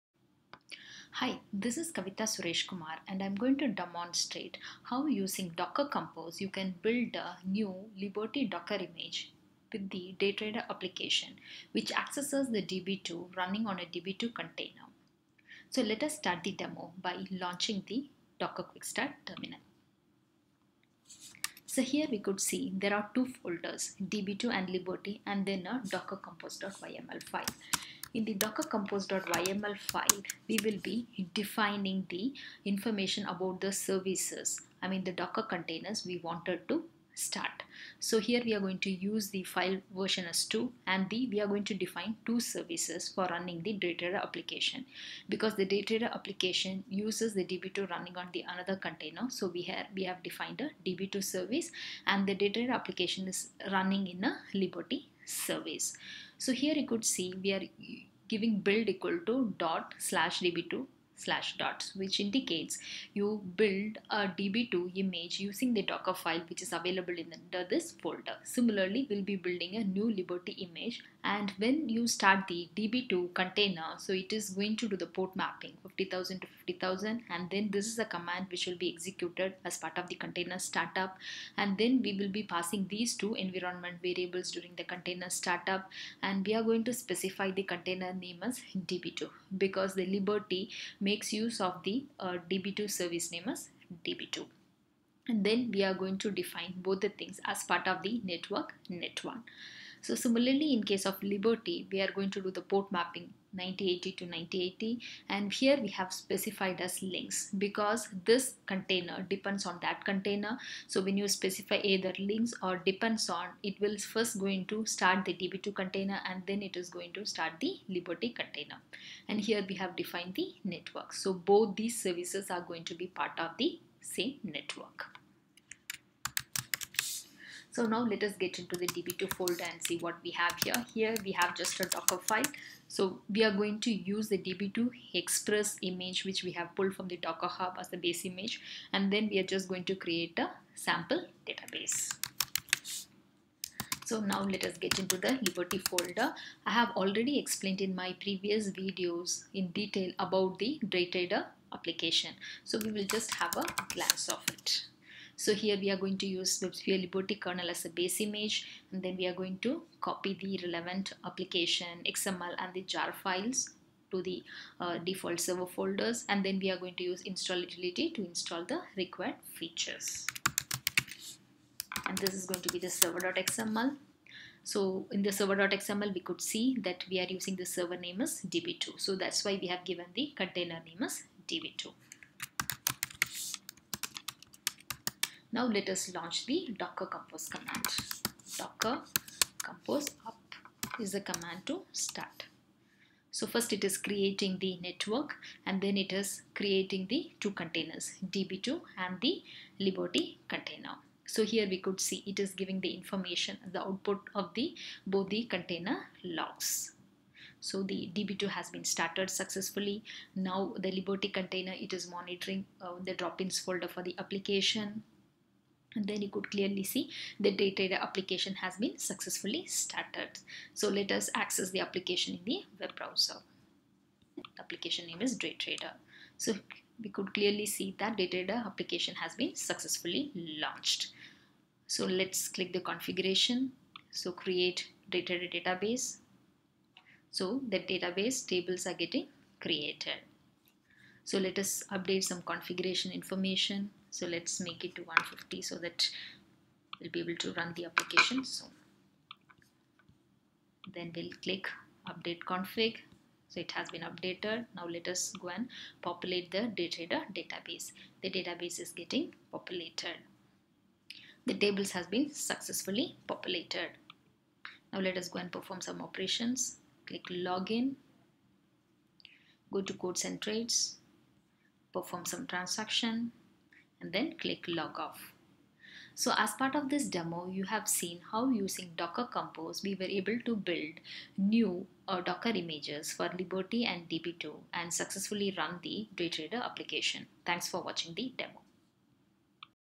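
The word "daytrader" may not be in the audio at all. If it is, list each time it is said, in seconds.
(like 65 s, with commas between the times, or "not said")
10 s, 150 s, 235 s, 286 s.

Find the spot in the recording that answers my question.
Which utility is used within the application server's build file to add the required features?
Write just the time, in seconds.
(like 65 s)
167 s.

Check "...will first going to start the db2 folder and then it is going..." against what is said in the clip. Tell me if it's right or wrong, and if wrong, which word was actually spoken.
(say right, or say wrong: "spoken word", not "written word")
wrong: "container", not "folder".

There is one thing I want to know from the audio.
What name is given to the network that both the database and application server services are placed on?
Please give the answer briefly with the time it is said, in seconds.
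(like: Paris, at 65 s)
net1, at 98 s.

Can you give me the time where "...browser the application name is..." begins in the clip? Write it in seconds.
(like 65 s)
222 s.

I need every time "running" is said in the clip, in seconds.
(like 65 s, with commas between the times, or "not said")
13 s, 43 s, 47 s, 53 s.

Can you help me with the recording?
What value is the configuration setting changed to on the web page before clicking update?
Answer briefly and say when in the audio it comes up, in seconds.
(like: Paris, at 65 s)
150, at 245 s.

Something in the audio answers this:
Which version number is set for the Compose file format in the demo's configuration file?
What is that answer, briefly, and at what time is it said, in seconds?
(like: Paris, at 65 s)
2, at 39 s.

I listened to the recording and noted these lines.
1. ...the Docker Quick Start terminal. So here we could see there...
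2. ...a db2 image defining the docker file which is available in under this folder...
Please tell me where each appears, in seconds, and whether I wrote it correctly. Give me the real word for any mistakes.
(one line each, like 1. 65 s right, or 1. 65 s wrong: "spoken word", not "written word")
1. 17 s right
2. 64 s wrong: "using", not "defining".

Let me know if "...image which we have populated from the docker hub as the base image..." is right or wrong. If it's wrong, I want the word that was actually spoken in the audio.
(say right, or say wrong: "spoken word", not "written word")
wrong: "pulled", not "populated".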